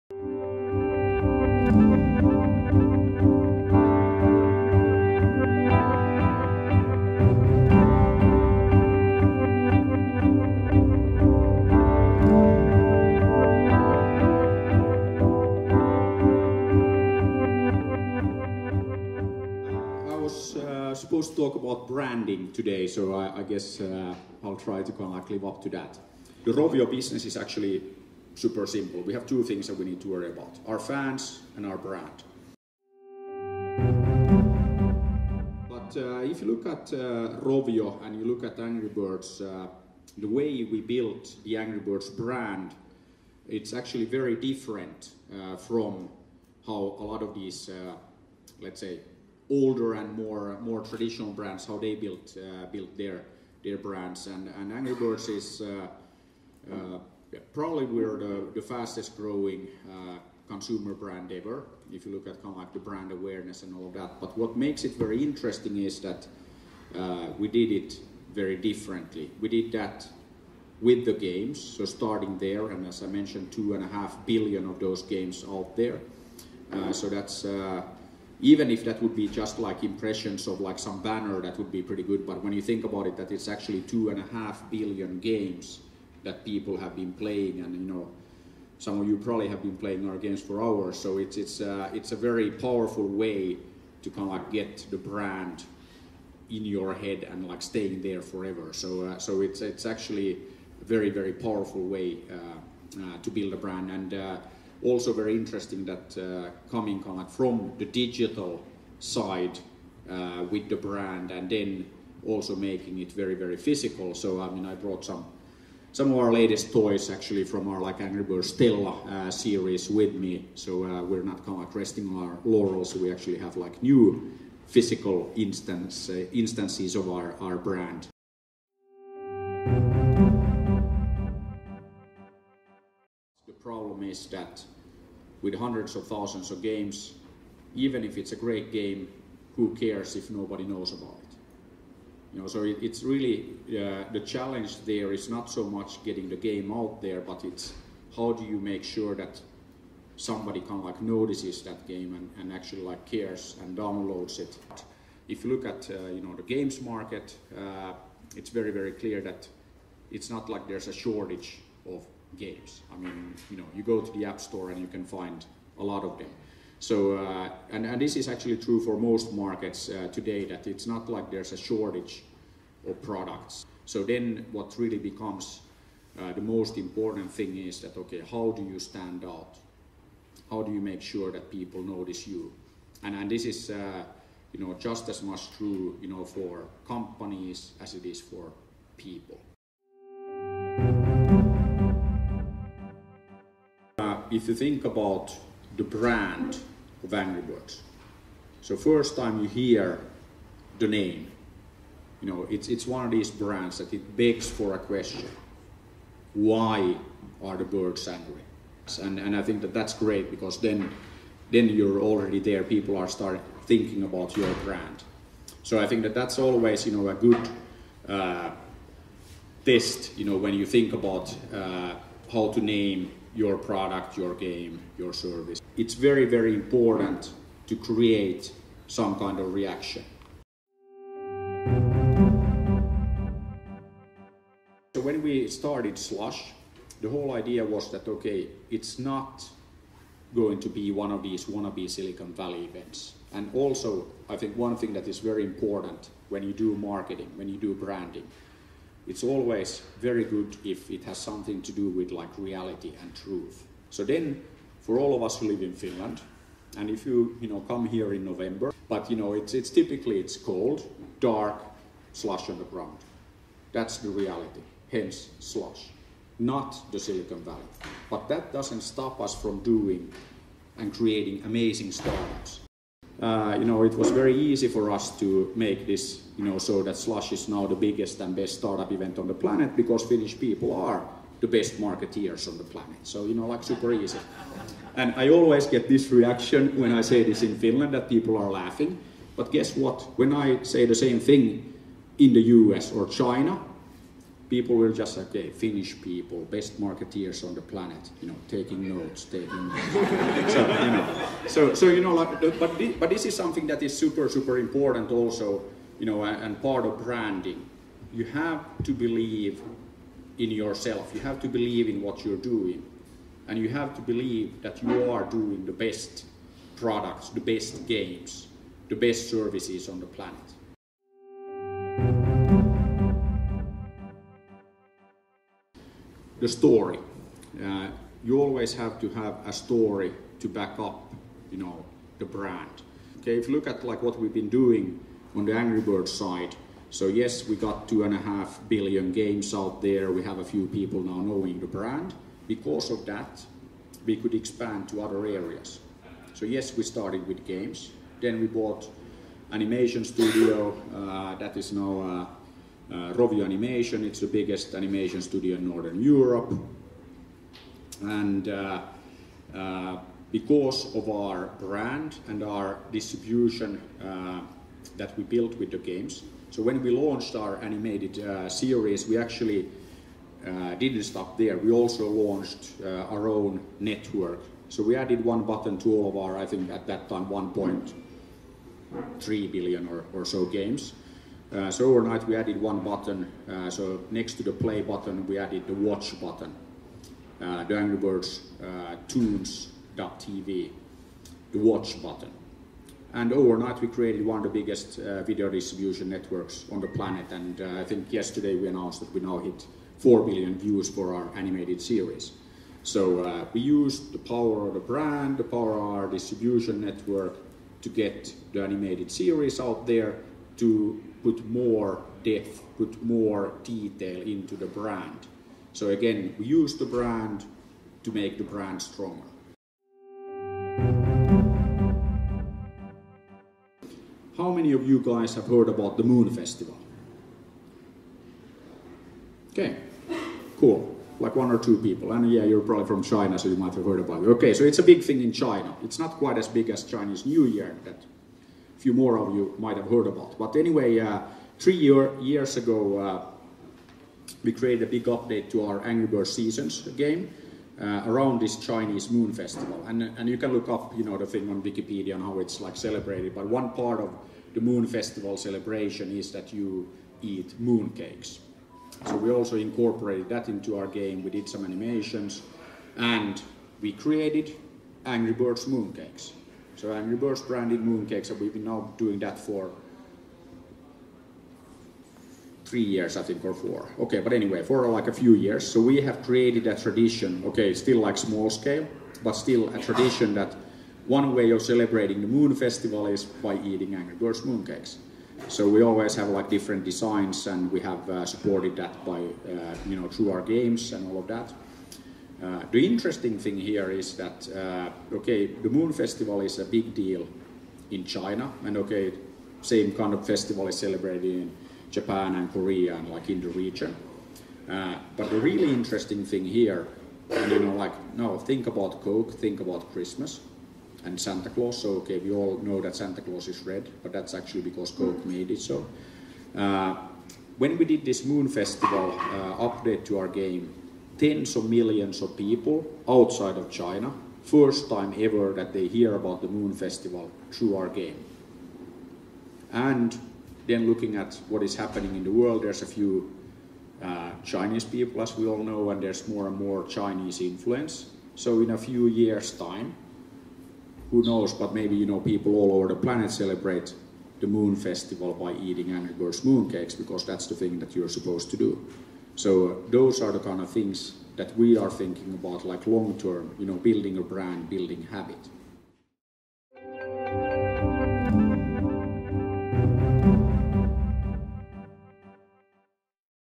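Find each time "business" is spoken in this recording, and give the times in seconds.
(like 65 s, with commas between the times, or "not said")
26 s.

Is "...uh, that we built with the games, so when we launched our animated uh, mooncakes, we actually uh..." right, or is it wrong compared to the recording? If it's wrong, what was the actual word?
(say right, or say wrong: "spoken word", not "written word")
wrong: "series", not "mooncakes".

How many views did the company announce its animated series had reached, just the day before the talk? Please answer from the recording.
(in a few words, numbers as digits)
4 billion.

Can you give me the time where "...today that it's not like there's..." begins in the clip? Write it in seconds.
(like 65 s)
170 s.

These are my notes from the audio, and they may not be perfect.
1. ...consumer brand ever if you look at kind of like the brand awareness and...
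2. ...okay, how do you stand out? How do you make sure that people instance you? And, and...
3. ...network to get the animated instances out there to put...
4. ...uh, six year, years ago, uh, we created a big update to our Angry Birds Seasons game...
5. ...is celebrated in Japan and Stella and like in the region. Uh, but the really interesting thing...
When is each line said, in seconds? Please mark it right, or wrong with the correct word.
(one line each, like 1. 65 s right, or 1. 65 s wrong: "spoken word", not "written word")
1. 60 s right
2. 177 s wrong: "notice", not "instance"
3. 406 s wrong: "series", not "instances"
4. 440 s wrong: "three", not "six"
5. 500 s wrong: "Korea", not "Stella".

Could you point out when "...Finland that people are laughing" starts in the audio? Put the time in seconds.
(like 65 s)
287 s.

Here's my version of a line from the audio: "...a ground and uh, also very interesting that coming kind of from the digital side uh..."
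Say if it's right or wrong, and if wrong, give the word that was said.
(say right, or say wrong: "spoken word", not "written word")
wrong: "brand", not "ground".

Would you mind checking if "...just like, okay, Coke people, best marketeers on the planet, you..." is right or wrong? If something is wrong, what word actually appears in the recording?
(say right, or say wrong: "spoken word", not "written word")
wrong: "Finnish", not "Coke".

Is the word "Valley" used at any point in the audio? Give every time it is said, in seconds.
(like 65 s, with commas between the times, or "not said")
242 s, 267 s.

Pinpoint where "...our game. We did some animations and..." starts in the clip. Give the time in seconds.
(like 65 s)
460 s.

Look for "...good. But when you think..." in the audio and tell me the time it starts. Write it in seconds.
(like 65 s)
82 s.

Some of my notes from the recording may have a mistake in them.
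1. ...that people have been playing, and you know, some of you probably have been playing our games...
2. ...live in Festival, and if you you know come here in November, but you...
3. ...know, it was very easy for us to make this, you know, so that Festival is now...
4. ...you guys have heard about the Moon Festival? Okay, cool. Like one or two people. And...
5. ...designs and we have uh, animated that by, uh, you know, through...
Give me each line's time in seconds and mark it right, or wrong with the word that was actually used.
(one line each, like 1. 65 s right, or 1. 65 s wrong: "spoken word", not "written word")
1. 86 s right
2. 255 s wrong: "Finland", not "Festival"
3. 273 s wrong: "Slush", not "Festival"
4. 424 s right
5. 486 s wrong: "supported", not "animated".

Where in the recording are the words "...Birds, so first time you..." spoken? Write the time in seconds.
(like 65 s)
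197 s.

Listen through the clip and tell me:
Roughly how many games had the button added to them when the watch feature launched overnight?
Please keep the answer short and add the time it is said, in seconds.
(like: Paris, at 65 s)
1.3 billion, at 377 s.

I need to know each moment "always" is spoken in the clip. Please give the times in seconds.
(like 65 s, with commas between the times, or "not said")
216 s, 249 s, 285 s, 328 s, 485 s.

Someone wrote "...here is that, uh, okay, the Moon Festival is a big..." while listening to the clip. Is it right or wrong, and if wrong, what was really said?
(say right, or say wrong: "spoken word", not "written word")
right.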